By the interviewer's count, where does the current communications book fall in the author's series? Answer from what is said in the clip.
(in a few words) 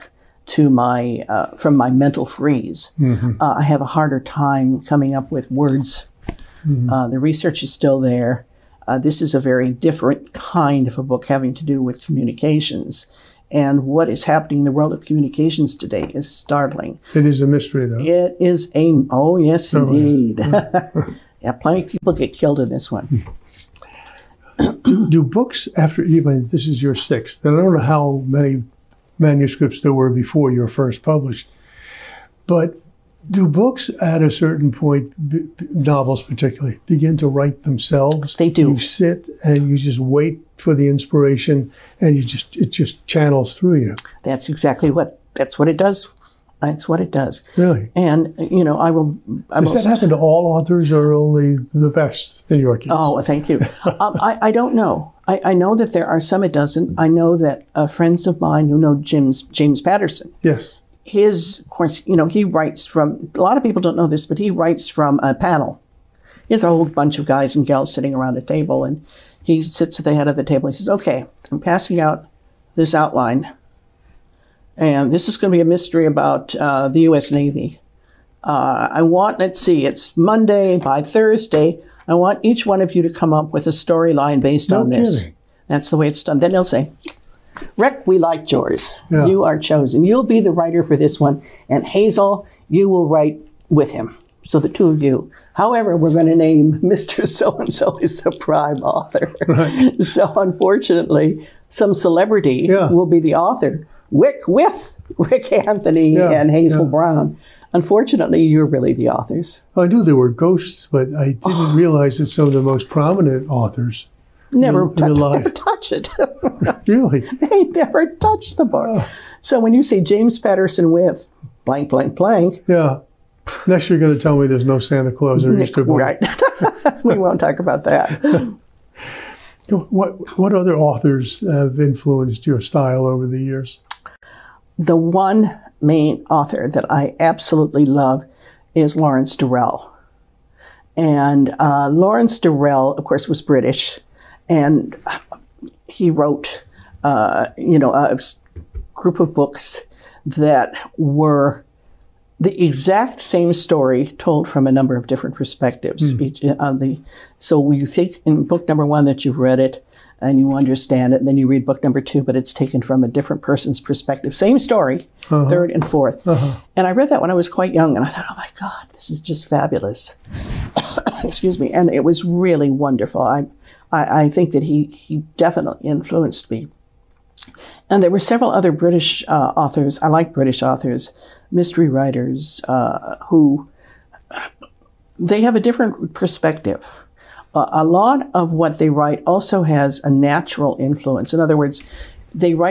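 sixth.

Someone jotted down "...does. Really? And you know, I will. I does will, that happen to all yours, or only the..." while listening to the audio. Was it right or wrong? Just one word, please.
wrong.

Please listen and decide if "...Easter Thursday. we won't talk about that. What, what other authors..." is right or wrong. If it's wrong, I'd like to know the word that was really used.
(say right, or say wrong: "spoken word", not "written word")
wrong: "Right", not "Thursday".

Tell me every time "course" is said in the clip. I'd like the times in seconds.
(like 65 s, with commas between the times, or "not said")
61 s, 143 s.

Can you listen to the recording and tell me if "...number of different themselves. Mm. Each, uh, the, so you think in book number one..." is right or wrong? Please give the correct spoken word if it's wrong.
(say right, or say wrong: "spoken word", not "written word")
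wrong: "perspectives", not "themselves".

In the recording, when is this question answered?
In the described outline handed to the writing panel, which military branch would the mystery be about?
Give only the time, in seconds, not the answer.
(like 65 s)
77 s.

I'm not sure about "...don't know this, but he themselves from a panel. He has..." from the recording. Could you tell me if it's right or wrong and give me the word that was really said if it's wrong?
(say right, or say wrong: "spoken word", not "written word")
wrong: "writes", not "themselves".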